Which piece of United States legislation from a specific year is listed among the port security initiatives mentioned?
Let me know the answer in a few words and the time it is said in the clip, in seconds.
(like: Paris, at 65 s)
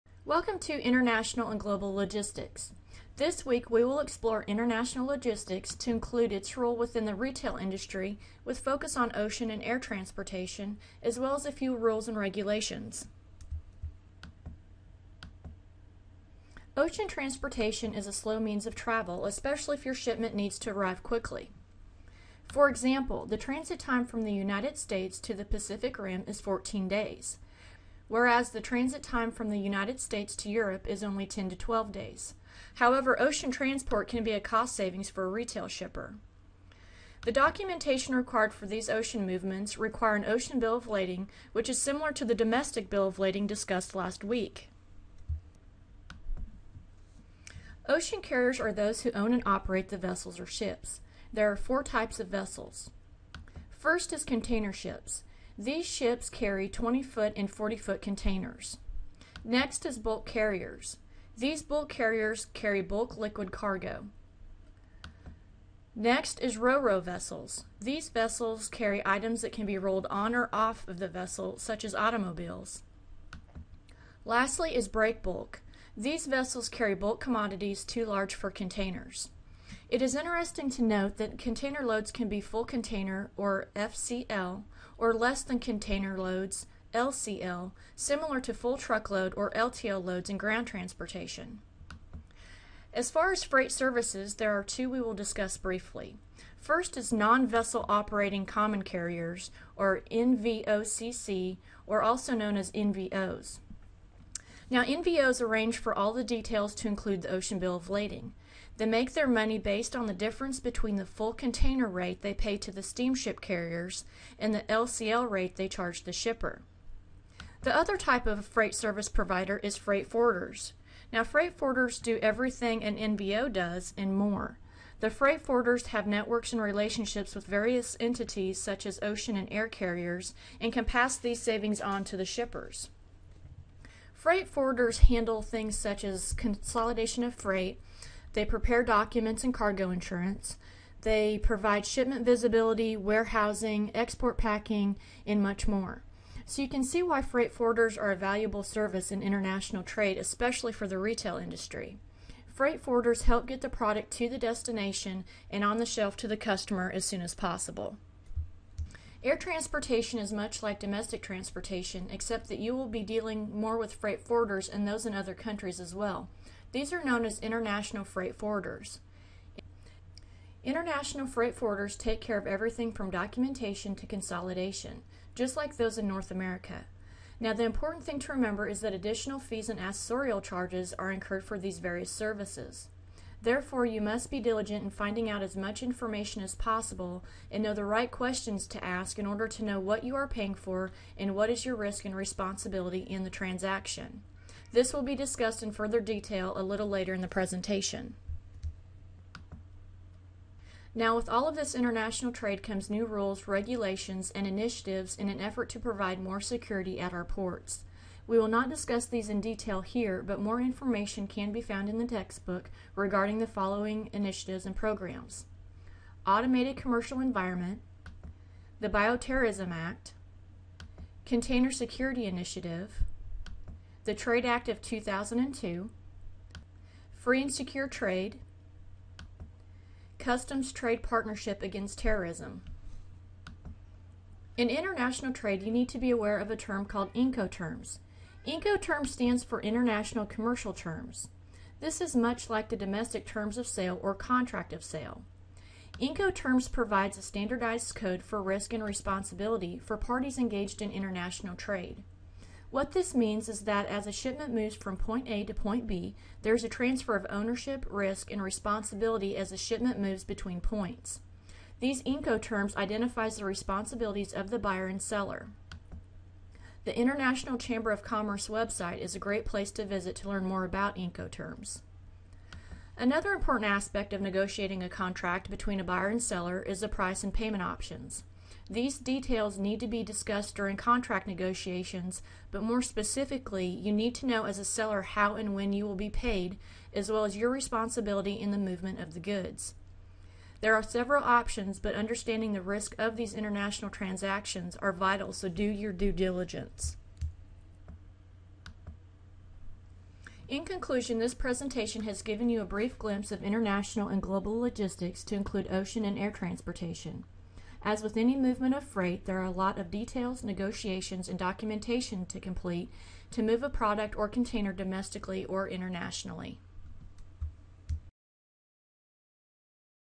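Trade Act of 2002, at 224 s.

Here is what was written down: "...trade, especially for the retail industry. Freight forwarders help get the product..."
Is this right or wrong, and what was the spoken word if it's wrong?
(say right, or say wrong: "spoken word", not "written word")
right.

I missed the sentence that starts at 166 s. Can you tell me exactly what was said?
These are known as international freight forwarders.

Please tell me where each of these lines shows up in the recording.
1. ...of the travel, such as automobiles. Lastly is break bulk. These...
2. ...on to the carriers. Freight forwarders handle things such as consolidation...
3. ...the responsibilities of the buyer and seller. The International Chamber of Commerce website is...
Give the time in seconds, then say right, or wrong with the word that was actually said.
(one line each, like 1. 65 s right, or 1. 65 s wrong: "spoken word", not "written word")
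1. 70 s wrong: "vessel", not "travel"
2. 131 s wrong: "shippers", not "carriers"
3. 263 s right.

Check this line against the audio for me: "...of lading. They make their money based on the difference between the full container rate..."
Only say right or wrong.
right.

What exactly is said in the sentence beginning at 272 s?
Another important aspect of negotiating a contract between a buyer and seller is the price and payment options.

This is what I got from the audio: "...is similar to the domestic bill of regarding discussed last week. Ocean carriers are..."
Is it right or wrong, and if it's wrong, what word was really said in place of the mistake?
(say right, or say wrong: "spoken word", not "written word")
wrong: "lading", not "regarding".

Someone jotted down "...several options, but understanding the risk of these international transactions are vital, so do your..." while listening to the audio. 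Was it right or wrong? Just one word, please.
right.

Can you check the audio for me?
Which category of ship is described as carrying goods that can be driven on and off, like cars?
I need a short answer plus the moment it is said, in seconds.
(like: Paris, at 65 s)
ro-ro vessels, at 66 s.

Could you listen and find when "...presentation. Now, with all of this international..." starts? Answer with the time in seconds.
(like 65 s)
197 s.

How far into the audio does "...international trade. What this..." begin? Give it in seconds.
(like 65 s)
250 s.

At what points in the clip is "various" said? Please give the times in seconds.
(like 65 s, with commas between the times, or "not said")
127 s, 181 s.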